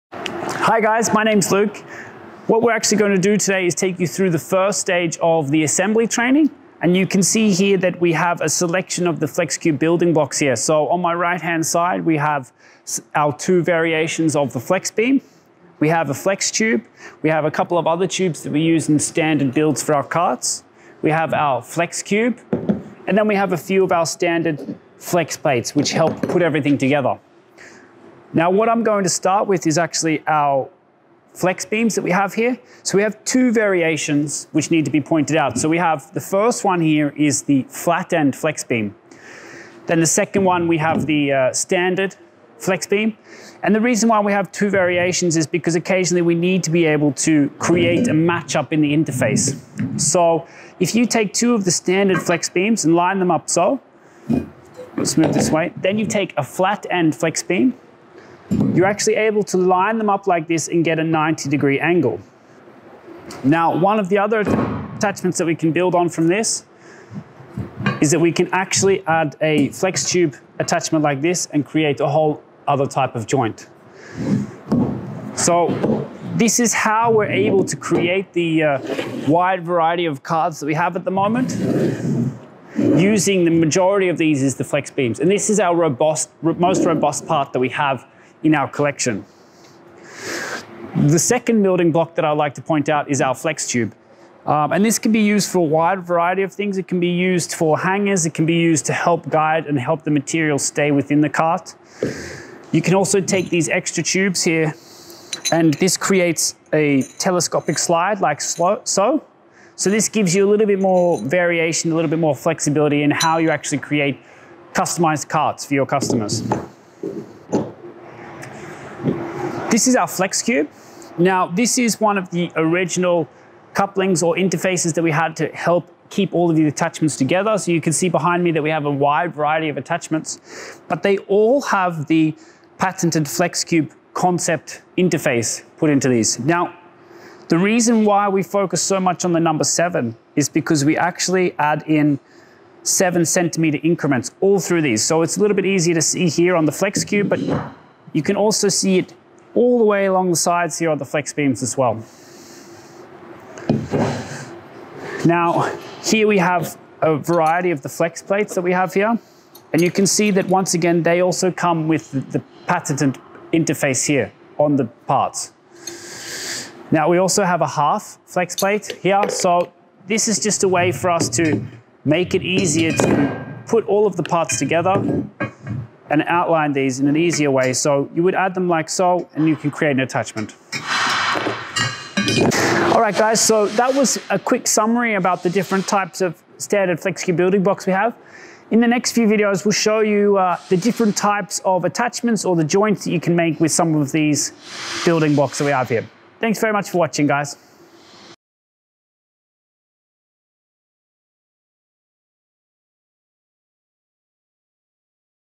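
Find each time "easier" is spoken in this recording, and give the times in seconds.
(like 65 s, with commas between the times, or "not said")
145 s, 172 s, 177 s.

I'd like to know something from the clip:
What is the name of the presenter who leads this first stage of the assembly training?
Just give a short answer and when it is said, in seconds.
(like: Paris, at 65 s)
Luke, at 1 s.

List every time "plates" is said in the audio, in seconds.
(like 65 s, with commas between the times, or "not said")
25 s, 158 s, 168 s.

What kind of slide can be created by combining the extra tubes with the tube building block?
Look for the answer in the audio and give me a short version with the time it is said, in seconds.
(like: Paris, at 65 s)
Telescopic slide, at 107 s.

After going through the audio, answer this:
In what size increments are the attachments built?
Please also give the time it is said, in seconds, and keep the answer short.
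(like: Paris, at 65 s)
7 centimeters, at 142 s.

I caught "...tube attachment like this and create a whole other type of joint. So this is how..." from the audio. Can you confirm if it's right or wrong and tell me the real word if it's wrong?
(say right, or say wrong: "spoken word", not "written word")
right.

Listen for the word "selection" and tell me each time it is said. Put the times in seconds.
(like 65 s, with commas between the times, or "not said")
8 s.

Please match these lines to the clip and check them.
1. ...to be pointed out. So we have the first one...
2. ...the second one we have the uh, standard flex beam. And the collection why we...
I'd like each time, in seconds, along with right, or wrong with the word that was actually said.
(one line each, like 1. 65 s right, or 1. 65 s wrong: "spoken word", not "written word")
1. 34 s right
2. 39 s wrong: "reason", not "collection".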